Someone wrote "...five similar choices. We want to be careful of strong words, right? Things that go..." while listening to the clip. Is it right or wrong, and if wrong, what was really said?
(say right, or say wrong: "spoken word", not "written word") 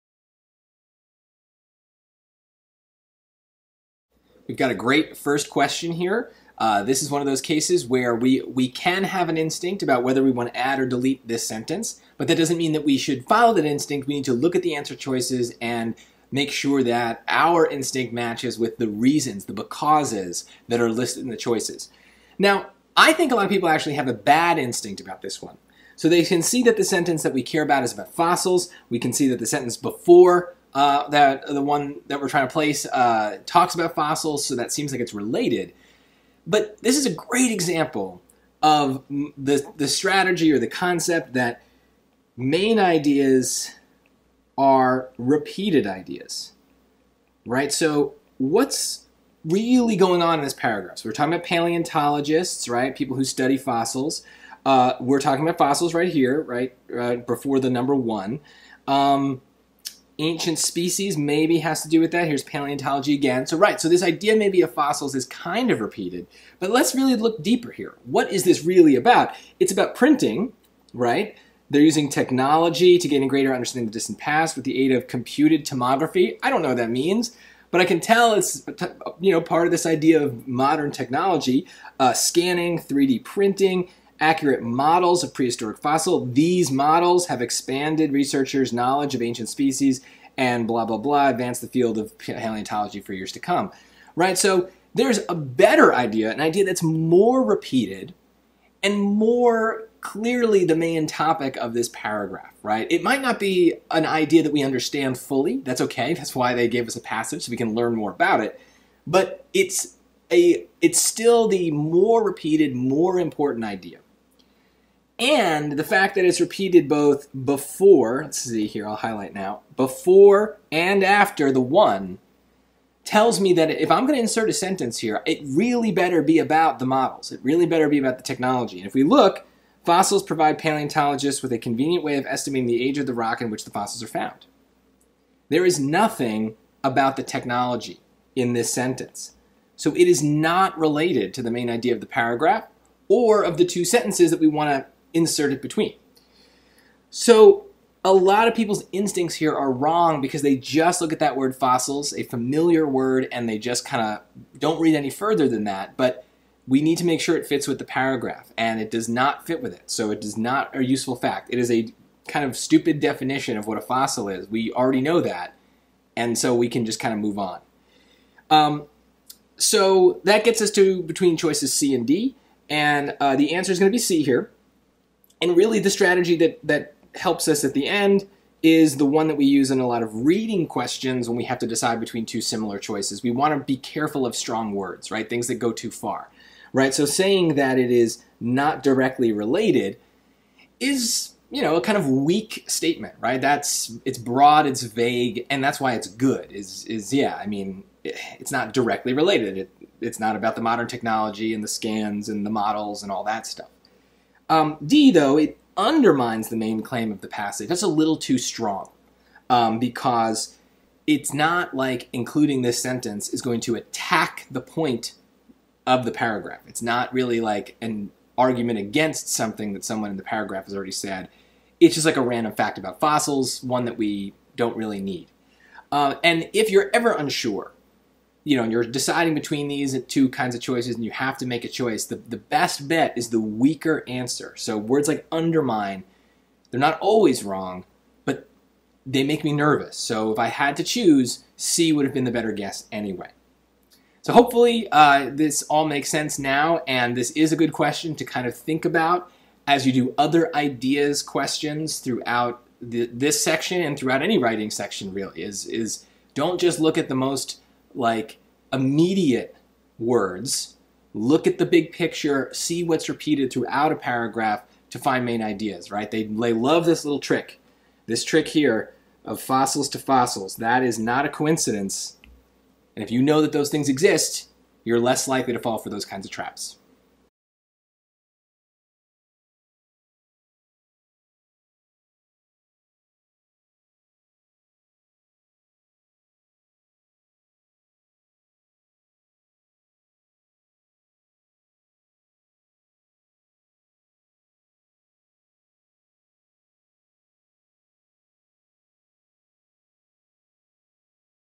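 wrong: "two", not "five".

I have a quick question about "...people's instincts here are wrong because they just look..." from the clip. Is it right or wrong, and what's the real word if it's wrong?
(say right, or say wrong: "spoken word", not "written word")
right.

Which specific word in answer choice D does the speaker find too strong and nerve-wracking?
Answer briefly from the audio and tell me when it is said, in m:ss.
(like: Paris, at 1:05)
undermine, at 3:25.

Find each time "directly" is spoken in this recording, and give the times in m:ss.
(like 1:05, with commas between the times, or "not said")
3:08, 3:18.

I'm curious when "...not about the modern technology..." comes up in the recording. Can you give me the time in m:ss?
3:20.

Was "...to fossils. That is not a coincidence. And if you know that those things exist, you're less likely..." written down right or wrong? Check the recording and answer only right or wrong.
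right.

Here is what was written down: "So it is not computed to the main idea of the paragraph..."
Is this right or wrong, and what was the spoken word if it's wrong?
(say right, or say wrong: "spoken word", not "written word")
wrong: "related", not "computed".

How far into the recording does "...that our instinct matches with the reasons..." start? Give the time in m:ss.
0:16.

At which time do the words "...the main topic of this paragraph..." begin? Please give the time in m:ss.
1:40.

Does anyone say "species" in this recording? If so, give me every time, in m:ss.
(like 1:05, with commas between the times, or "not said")
1:00, 1:29.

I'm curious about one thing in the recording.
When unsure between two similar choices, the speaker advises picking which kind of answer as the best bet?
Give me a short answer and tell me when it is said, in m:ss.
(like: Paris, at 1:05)
the weaker answer, at 3:53.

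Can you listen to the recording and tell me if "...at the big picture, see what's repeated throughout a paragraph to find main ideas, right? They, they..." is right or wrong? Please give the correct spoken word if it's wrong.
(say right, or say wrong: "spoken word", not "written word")
right.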